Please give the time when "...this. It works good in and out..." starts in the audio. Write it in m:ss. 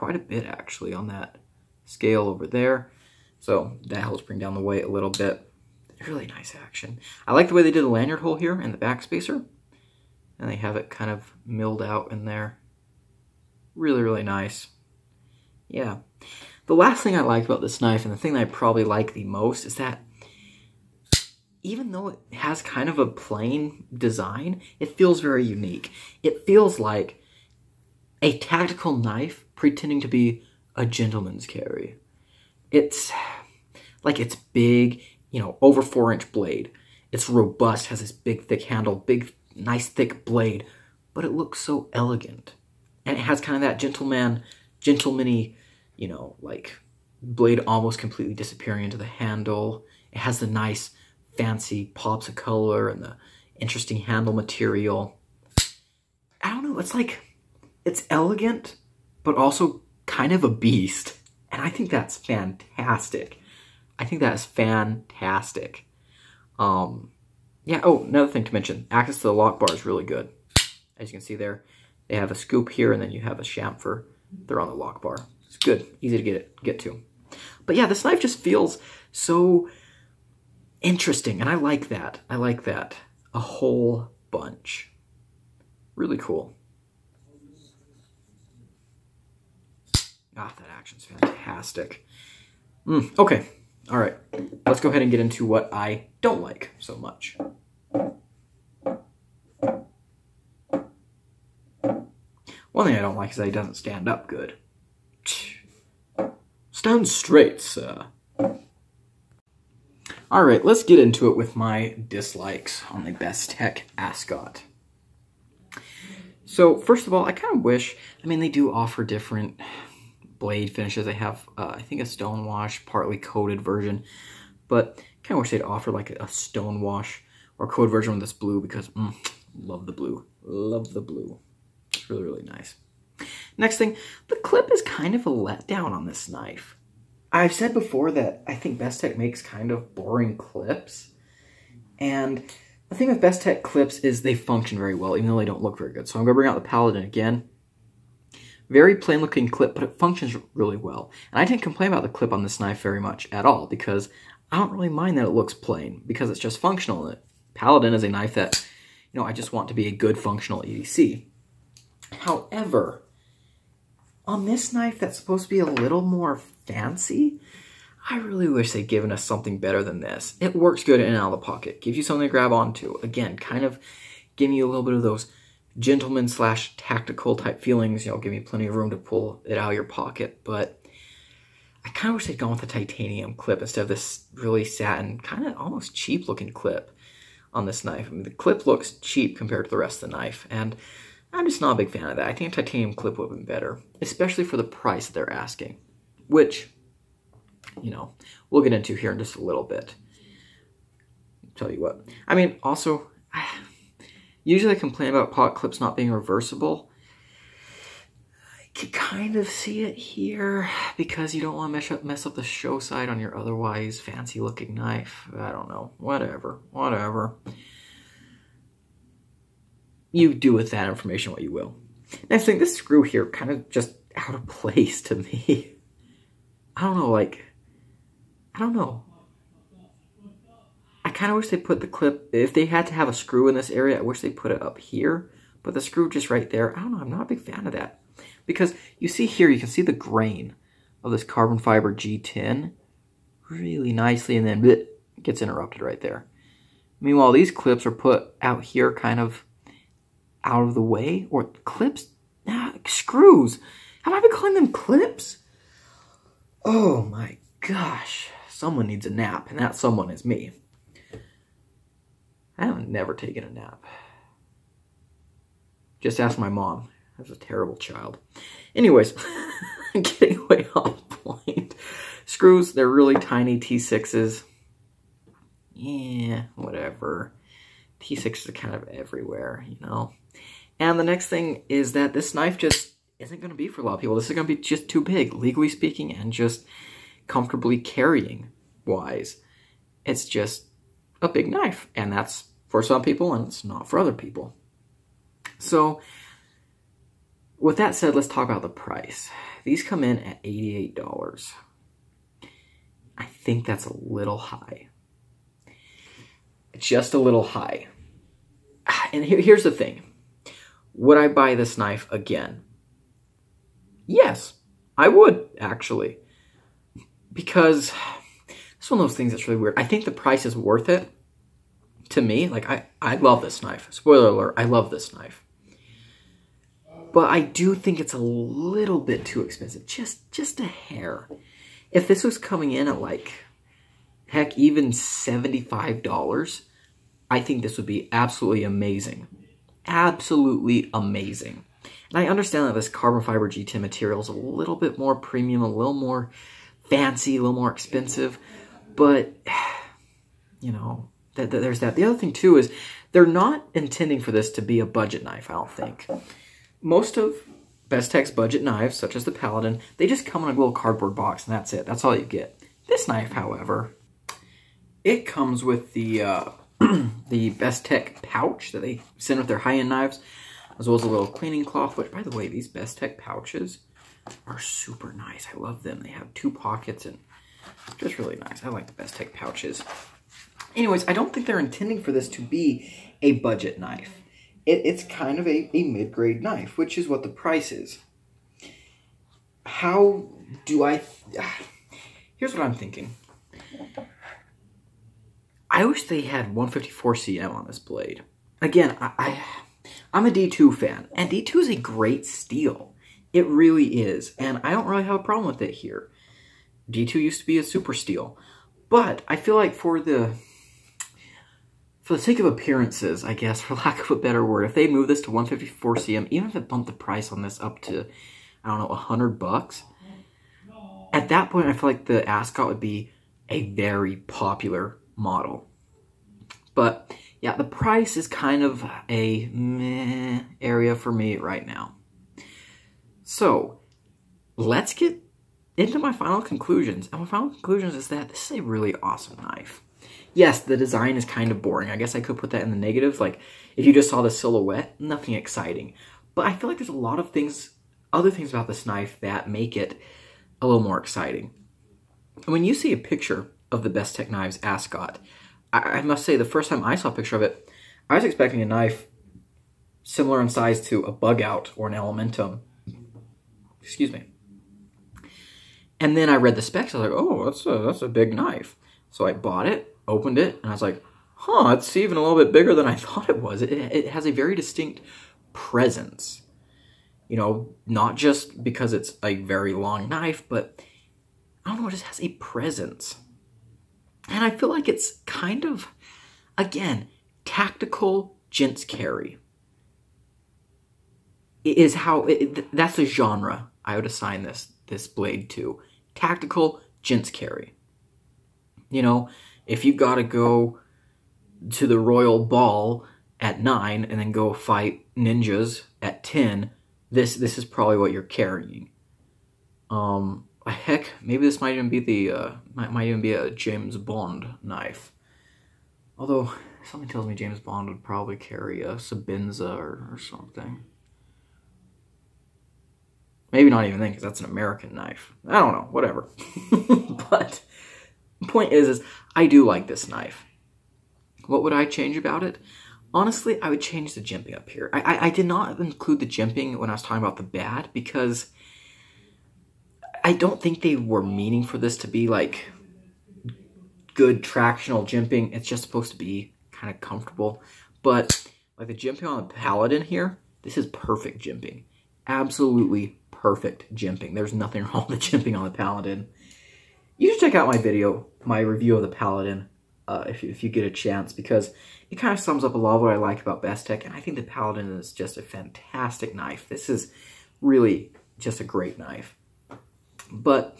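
2:49.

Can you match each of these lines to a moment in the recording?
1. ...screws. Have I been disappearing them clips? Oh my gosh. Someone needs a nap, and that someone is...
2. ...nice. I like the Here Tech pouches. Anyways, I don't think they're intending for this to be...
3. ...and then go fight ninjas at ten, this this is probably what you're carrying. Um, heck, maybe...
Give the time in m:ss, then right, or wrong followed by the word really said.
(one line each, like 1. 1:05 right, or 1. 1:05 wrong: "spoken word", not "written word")
1. 4:12 wrong: "calling", not "disappearing"
2. 6:18 wrong: "Best", not "Here"
3. 8:24 right.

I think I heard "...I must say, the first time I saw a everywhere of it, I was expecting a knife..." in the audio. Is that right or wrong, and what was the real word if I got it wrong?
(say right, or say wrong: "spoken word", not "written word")
wrong: "picture", not "everywhere".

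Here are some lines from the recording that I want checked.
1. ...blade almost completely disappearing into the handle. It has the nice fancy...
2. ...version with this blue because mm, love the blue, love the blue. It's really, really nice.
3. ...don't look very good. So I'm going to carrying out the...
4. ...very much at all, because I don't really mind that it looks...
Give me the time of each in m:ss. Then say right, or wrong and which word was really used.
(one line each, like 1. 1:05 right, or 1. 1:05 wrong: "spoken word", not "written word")
1. 0:47 right
2. 2:07 right
3. 2:25 wrong: "bring", not "carrying"
4. 2:32 right.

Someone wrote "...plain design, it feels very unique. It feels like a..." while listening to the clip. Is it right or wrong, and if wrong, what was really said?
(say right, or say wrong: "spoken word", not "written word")
right.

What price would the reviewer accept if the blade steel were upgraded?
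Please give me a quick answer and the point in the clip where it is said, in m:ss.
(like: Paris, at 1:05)
100 bucks, at 6:58.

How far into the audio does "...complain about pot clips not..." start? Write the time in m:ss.
3:24.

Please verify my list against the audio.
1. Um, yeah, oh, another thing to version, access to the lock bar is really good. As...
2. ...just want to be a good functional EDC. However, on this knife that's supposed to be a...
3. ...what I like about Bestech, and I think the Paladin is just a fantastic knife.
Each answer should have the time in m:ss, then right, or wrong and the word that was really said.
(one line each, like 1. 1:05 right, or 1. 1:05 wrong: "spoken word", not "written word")
1. 1:06 wrong: "mention", not "version"
2. 2:39 right
3. 9:23 right.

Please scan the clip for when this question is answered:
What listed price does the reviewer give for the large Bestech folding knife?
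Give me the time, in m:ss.
5:00.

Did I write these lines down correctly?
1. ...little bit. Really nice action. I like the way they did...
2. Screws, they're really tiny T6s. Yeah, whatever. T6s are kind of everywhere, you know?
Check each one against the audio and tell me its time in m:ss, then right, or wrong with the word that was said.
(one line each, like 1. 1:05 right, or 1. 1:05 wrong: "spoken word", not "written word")
1. 0:04 right
2. 4:32 right.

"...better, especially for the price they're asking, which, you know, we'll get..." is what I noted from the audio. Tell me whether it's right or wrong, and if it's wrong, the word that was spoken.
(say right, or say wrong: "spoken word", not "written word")
right.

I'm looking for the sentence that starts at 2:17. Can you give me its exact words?
I've said before that I think Bestech makes kind of boring clips.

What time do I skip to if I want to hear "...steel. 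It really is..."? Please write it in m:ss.
6:42.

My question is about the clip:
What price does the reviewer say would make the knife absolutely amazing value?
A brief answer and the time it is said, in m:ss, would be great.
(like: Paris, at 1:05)
$75, at 5:34.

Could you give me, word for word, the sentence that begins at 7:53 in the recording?
It, it has a very distinct presence.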